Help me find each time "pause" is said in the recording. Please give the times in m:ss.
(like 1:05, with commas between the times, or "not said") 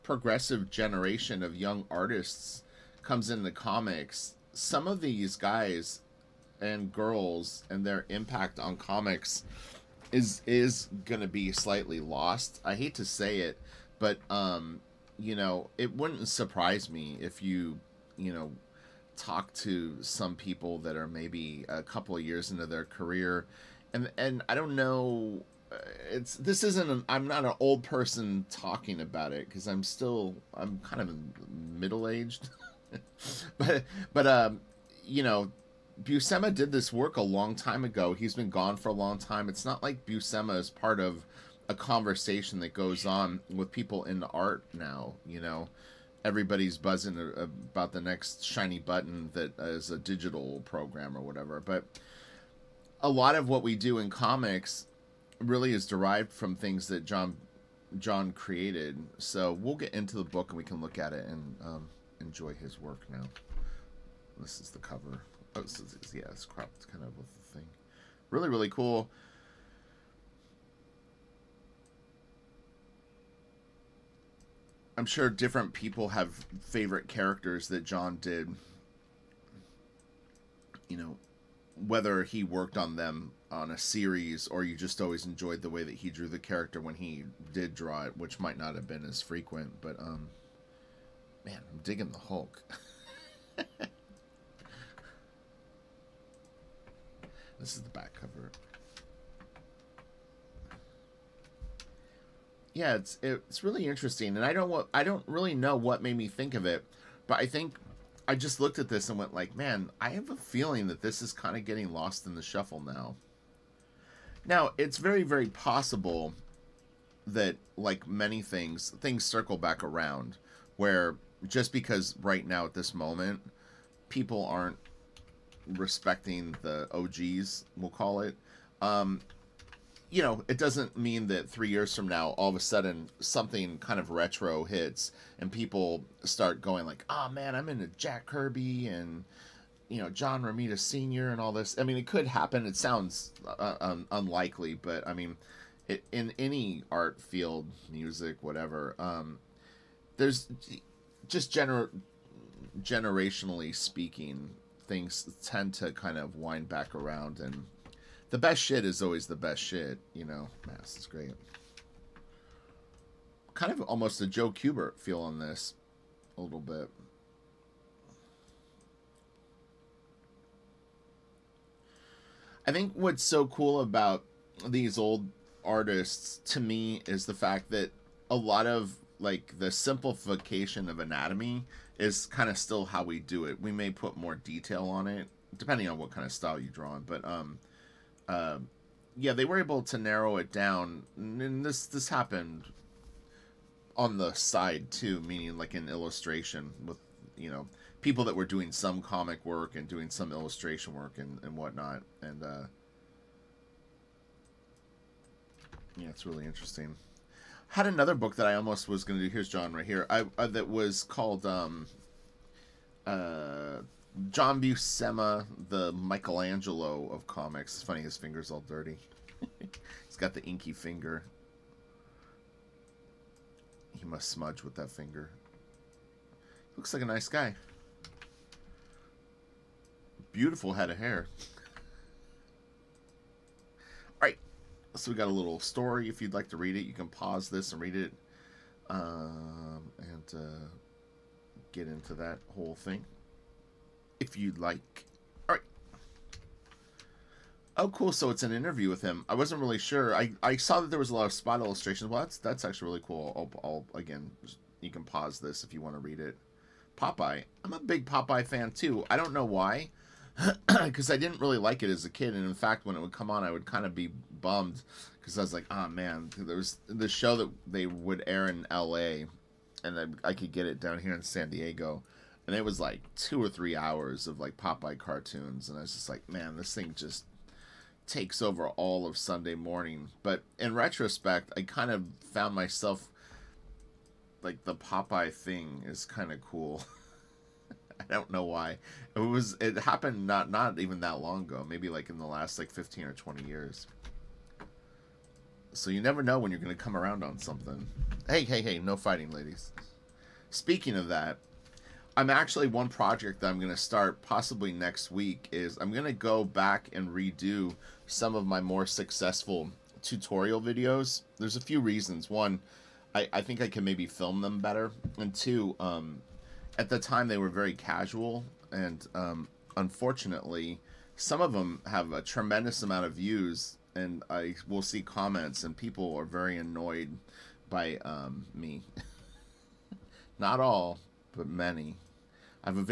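3:57, 4:15.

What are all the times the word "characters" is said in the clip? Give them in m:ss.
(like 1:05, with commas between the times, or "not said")
1:17, 1:26.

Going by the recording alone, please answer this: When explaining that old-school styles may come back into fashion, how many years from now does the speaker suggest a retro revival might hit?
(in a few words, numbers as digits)
3 years.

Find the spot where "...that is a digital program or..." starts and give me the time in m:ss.
0:49.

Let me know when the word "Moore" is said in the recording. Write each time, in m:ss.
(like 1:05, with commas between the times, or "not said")
not said.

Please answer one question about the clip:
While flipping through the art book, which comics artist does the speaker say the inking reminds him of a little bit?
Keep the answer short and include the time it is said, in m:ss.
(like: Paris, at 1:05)
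Joe Kubert, at 2:44.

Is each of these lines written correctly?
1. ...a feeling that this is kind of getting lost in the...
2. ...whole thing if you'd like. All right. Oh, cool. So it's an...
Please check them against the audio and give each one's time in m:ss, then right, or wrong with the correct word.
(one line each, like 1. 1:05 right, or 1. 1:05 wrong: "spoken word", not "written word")
1. 1:50 right
2. 4:02 right.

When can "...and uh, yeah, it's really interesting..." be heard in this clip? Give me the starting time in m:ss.
3:22.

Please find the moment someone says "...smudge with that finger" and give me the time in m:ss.
3:44.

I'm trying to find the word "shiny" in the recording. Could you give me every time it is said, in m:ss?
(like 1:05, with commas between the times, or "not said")
0:48.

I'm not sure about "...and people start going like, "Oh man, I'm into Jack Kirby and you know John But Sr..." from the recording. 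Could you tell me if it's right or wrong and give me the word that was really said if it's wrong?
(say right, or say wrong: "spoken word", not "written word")
wrong: "Romita", not "But".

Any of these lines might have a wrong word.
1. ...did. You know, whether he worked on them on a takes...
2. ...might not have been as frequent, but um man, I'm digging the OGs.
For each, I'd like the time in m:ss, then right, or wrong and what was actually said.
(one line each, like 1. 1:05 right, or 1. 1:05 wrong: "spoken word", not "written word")
1. 1:18 wrong: "series", not "takes"
2. 1:28 wrong: "Hulk", not "OGs".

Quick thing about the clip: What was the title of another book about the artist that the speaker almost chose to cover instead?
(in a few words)
The Michelangelo of Comics.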